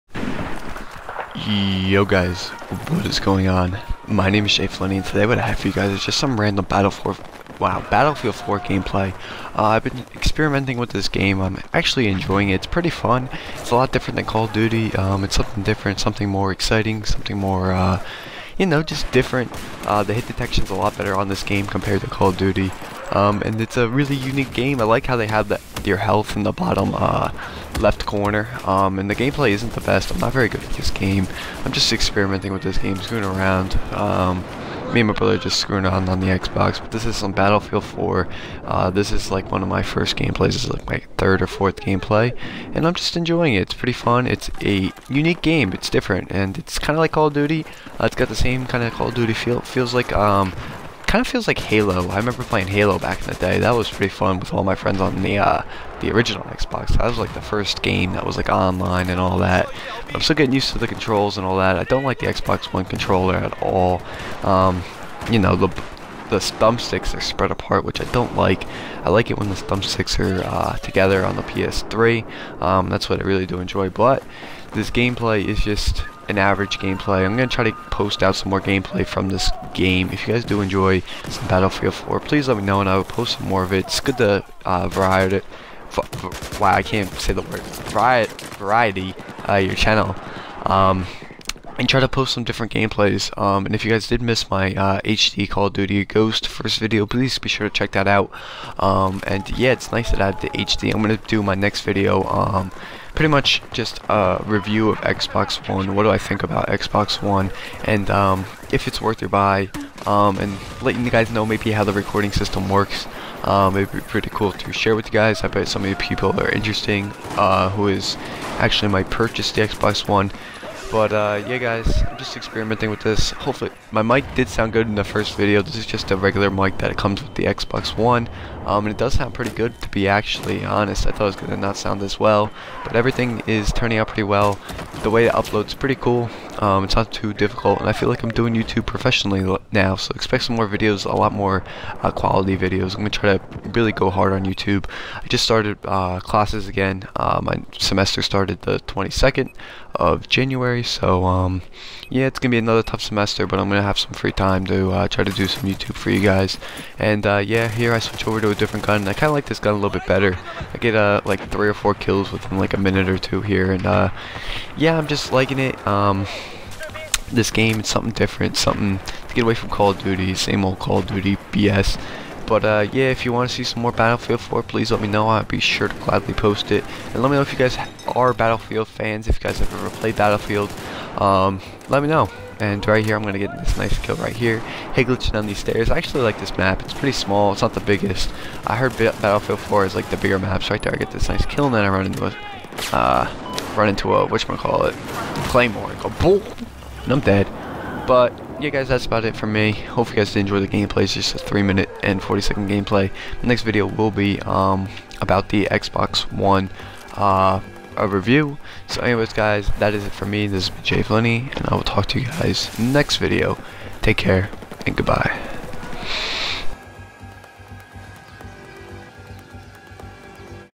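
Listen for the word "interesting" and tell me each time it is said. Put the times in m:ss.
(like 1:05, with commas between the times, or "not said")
1:56.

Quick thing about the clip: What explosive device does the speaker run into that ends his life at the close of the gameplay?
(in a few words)
Claymore.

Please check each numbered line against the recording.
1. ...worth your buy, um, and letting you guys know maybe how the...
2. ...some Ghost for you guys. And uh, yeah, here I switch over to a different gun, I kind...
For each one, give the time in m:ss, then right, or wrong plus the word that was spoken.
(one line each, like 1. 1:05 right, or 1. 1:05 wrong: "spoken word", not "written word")
1. 1:49 right
2. 2:35 wrong: "YouTube", not "Ghost".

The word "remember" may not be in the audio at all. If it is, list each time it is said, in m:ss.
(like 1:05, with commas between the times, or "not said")
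0:52.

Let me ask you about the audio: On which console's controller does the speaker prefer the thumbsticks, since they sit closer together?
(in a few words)
PS3.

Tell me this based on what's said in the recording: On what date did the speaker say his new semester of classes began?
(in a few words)
January 22.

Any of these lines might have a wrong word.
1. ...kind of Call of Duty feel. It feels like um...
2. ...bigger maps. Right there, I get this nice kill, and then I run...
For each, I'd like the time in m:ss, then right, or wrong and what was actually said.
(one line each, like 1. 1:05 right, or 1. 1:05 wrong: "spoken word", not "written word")
1. 0:48 right
2. 3:10 right.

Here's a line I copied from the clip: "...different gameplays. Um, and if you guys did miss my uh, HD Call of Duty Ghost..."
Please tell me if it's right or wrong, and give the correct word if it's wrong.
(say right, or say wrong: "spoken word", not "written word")
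right.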